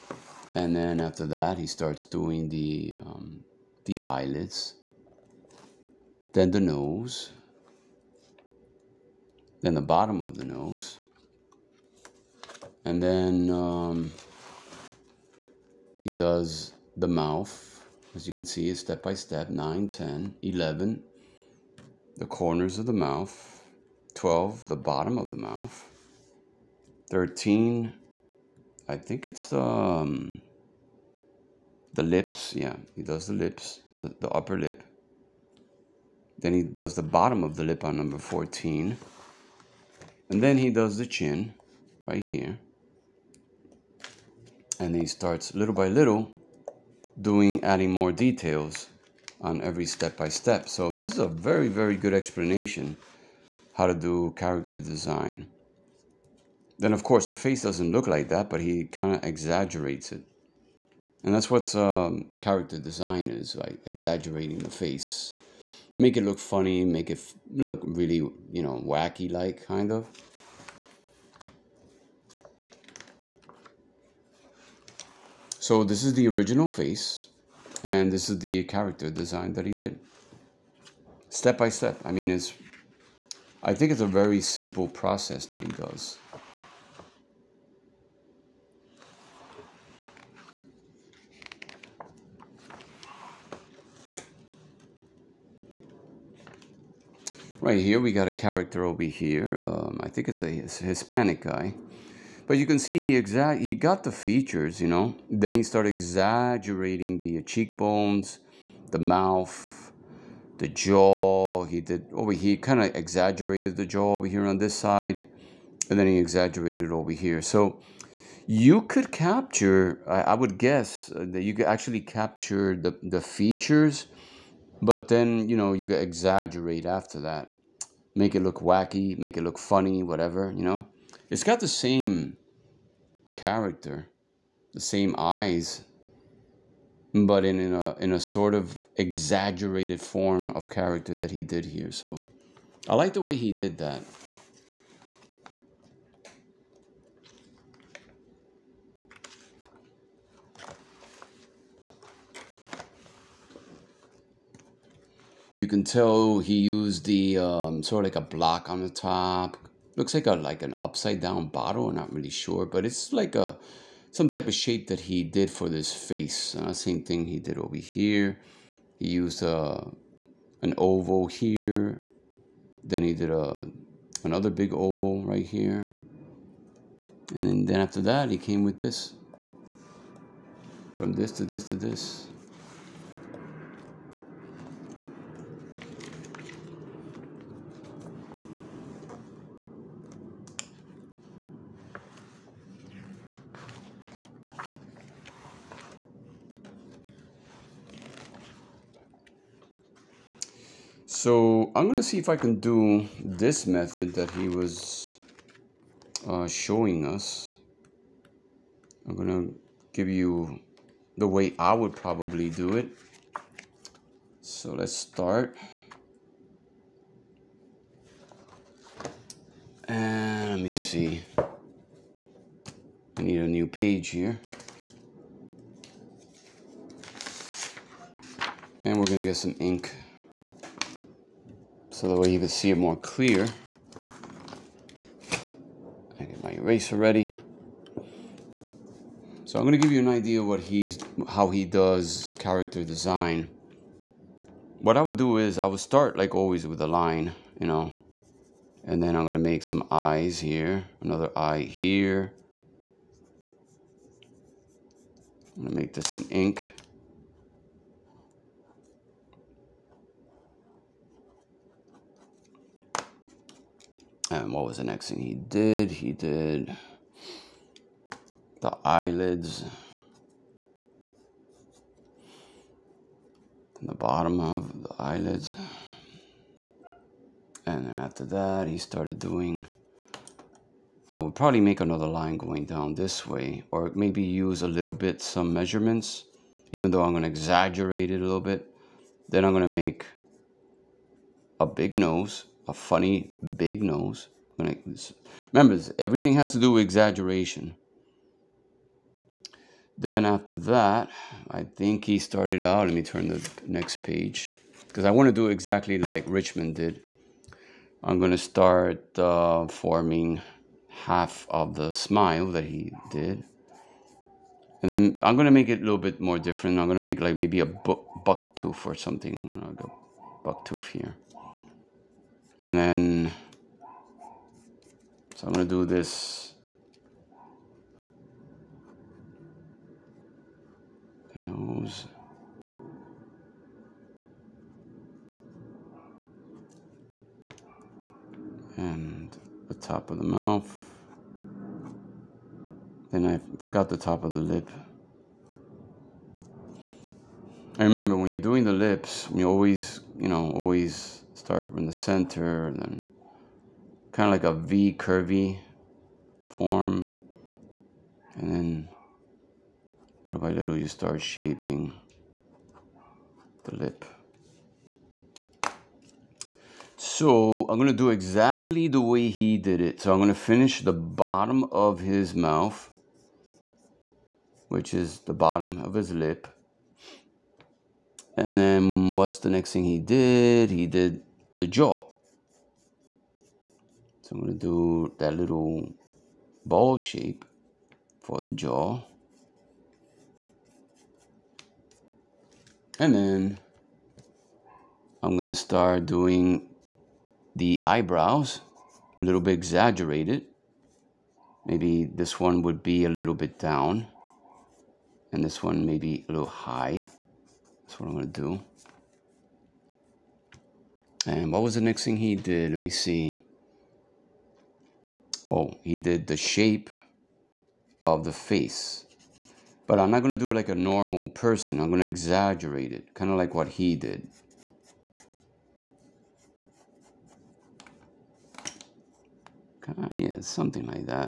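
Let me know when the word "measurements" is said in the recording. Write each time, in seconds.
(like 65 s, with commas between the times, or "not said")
285 s.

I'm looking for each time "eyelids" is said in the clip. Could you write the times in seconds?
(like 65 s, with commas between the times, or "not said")
4 s, 268 s, 274 s.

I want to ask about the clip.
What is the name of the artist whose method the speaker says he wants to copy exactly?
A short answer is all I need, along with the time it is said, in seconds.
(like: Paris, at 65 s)
Richmond, at 306 s.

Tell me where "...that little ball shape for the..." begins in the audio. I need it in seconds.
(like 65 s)
385 s.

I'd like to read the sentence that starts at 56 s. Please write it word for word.
Then of course the face doesn't look like that, but he kind of exaggerates it.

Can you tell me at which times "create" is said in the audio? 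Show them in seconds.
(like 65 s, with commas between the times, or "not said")
not said.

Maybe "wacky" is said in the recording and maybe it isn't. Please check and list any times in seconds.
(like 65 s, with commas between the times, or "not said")
68 s, 128 s.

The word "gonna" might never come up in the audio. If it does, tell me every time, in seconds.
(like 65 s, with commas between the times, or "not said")
201 s, 209 s, 229 s, 325 s.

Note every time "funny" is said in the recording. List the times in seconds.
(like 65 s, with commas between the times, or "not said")
66 s, 129 s, 292 s.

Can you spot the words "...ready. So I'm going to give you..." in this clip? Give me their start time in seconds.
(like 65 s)
236 s.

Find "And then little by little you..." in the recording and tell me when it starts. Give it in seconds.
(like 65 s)
358 s.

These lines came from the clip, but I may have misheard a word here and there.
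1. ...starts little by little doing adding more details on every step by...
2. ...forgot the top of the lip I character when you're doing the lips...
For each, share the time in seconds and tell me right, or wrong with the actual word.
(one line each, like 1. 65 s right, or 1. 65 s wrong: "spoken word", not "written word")
1. 45 s right
2. 343 s wrong: "remember", not "character".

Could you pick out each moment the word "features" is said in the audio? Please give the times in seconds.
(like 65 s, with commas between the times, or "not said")
104 s, 123 s.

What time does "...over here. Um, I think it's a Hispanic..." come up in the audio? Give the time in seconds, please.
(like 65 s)
98 s.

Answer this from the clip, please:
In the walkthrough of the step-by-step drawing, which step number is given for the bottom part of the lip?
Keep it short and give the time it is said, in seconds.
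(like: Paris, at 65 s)
14, at 37 s.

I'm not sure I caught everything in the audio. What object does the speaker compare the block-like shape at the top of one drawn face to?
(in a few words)
An upside down bottle.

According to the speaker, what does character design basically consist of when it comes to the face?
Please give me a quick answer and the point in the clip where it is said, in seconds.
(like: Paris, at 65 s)
Exaggerating the face, at 63 s.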